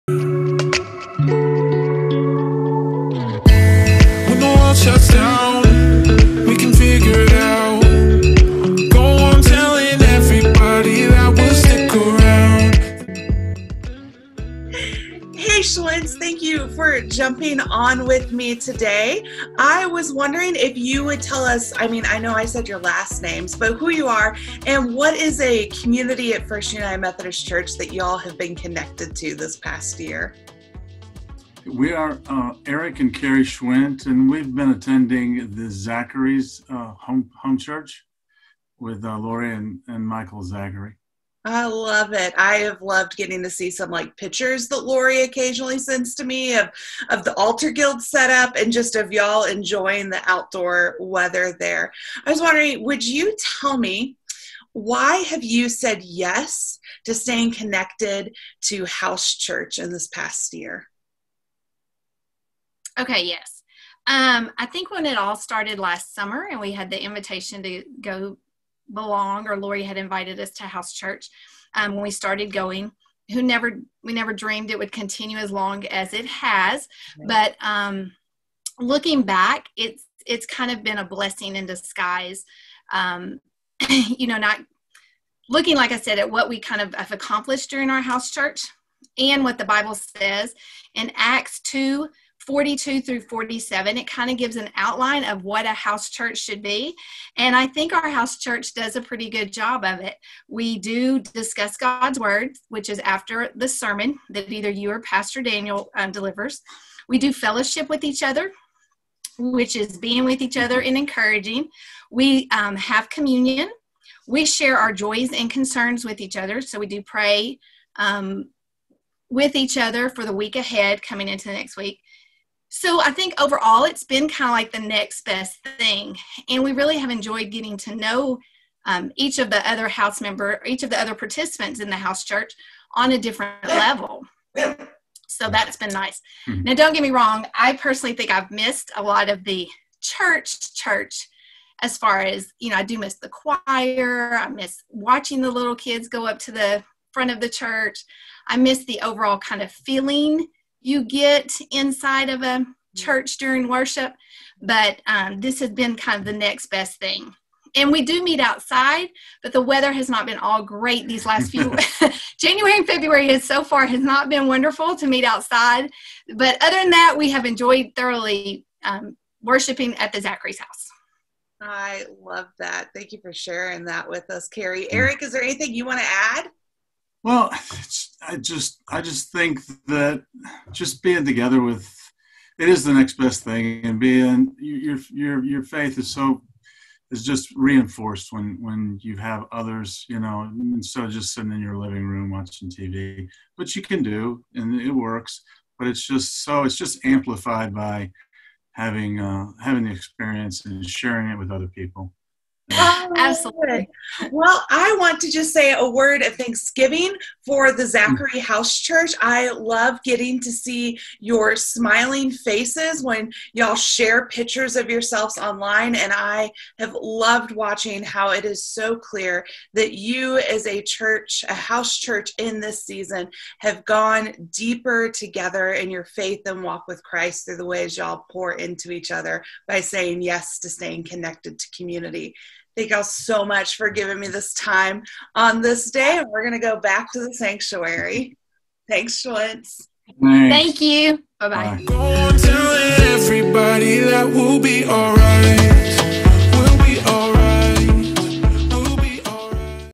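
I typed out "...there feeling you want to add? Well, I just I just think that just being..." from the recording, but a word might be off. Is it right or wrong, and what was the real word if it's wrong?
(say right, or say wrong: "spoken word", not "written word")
wrong: "anything", not "feeling".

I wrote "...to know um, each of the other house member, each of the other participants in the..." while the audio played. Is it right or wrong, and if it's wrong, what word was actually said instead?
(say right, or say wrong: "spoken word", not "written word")
right.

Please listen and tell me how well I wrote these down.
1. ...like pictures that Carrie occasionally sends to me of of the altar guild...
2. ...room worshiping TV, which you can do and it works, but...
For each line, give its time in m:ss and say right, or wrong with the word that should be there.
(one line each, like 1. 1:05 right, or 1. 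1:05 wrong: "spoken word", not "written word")
1. 0:43 wrong: "Lori", not "Carrie"
2. 3:12 wrong: "watching", not "worshiping".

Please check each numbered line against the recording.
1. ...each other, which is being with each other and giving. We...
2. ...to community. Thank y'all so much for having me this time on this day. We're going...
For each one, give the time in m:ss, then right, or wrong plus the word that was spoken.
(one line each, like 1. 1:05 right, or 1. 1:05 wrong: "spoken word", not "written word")
1. 1:48 wrong: "encouraging", not "giving"
2. 3:51 wrong: "giving", not "having".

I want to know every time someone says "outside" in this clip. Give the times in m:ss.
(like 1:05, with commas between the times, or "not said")
2:38, 2:45.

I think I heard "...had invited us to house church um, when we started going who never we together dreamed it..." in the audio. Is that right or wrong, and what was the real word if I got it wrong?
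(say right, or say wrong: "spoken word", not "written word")
wrong: "never", not "together".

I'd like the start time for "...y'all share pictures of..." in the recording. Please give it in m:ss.
3:33.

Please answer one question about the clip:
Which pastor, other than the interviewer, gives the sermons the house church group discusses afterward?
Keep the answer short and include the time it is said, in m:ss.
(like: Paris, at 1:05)
Pastor Daniel, at 1:44.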